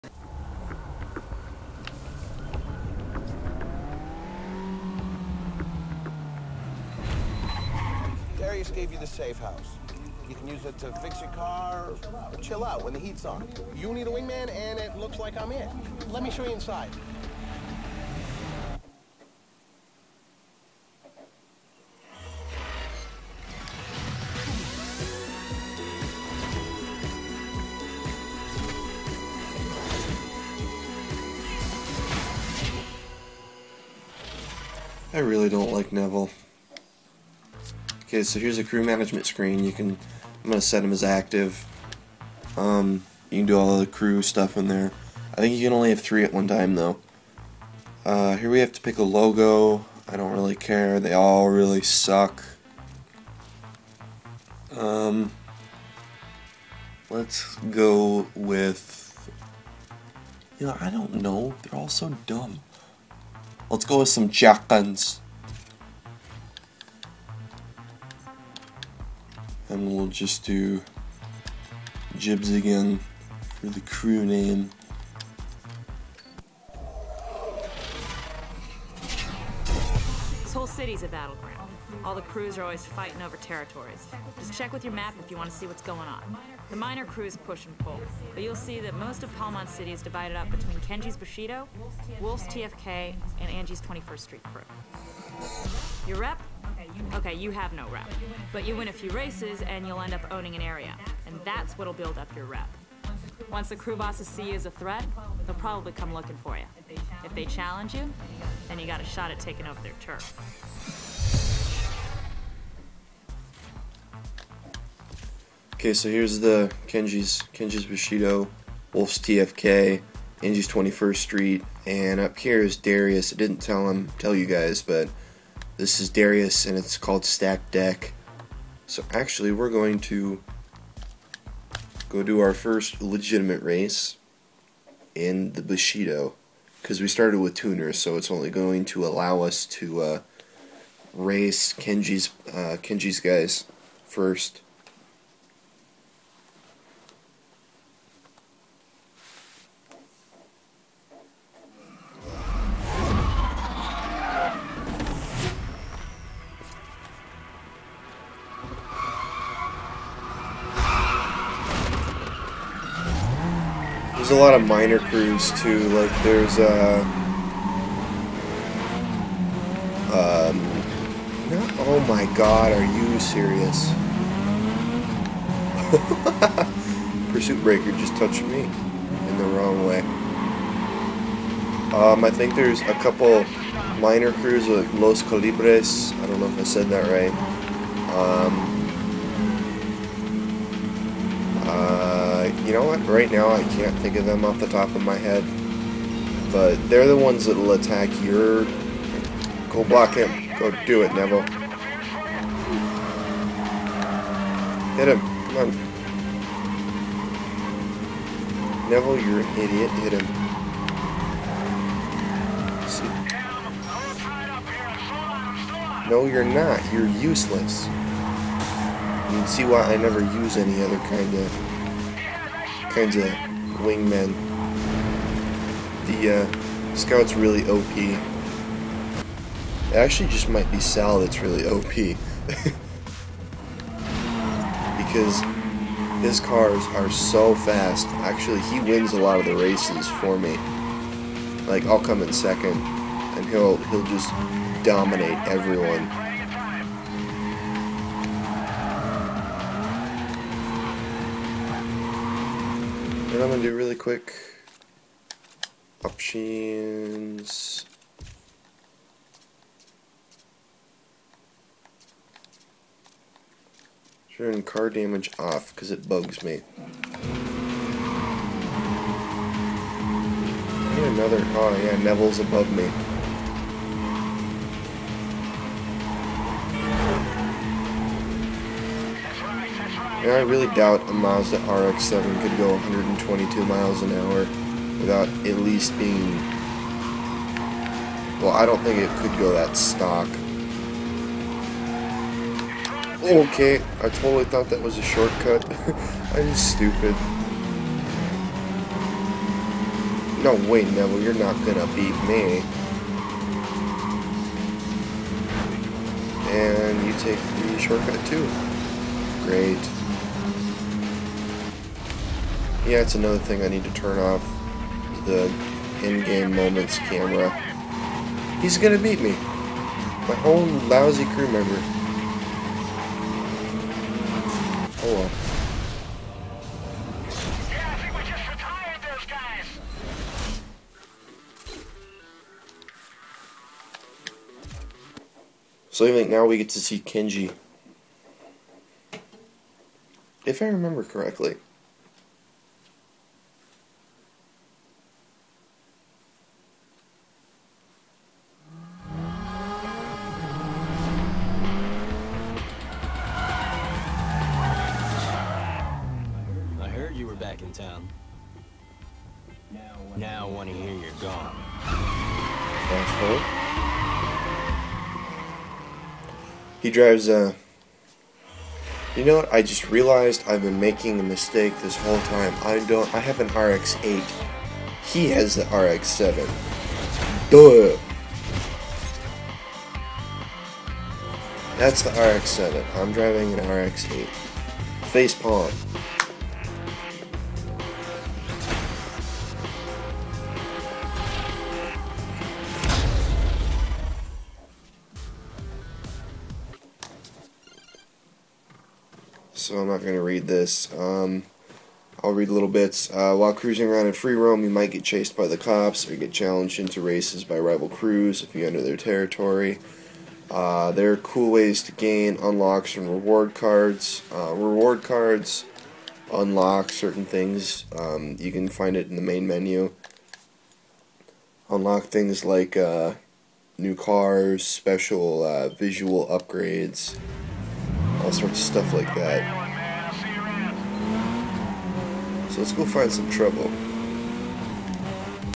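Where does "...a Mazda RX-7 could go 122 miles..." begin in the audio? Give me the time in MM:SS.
04:41.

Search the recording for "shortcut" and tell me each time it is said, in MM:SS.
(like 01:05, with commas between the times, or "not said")
04:55, 05:07.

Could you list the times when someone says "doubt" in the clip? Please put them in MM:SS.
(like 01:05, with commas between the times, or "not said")
04:40.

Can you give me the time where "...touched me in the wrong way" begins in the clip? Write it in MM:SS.
02:58.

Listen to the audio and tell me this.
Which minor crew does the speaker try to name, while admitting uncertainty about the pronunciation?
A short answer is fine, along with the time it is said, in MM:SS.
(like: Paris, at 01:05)
Los Calibres, at 03:04.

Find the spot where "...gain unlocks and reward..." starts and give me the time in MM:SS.
06:51.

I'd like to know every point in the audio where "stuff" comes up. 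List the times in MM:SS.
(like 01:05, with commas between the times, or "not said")
00:44, 07:08.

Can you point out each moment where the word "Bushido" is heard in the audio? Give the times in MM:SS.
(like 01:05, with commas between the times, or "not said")
01:31, 01:57, 02:15.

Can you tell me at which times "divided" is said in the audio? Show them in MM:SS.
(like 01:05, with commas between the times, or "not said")
01:30.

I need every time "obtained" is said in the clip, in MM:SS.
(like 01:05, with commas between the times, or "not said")
not said.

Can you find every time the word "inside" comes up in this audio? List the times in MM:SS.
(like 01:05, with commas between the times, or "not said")
00:16.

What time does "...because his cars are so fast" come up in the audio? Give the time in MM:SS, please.
03:54.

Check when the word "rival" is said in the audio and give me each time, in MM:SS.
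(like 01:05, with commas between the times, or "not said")
06:47.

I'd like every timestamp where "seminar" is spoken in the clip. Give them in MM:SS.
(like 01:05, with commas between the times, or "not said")
not said.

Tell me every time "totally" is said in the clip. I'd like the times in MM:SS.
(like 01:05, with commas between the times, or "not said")
04:54.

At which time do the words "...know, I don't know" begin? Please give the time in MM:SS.
01:00.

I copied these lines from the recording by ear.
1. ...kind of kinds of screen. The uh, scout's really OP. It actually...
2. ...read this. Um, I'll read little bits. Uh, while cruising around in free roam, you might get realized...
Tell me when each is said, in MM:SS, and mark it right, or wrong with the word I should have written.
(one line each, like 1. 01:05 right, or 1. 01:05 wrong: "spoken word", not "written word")
1. 03:41 wrong: "wingmen", not "screen"
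2. 06:40 wrong: "chased", not "realized".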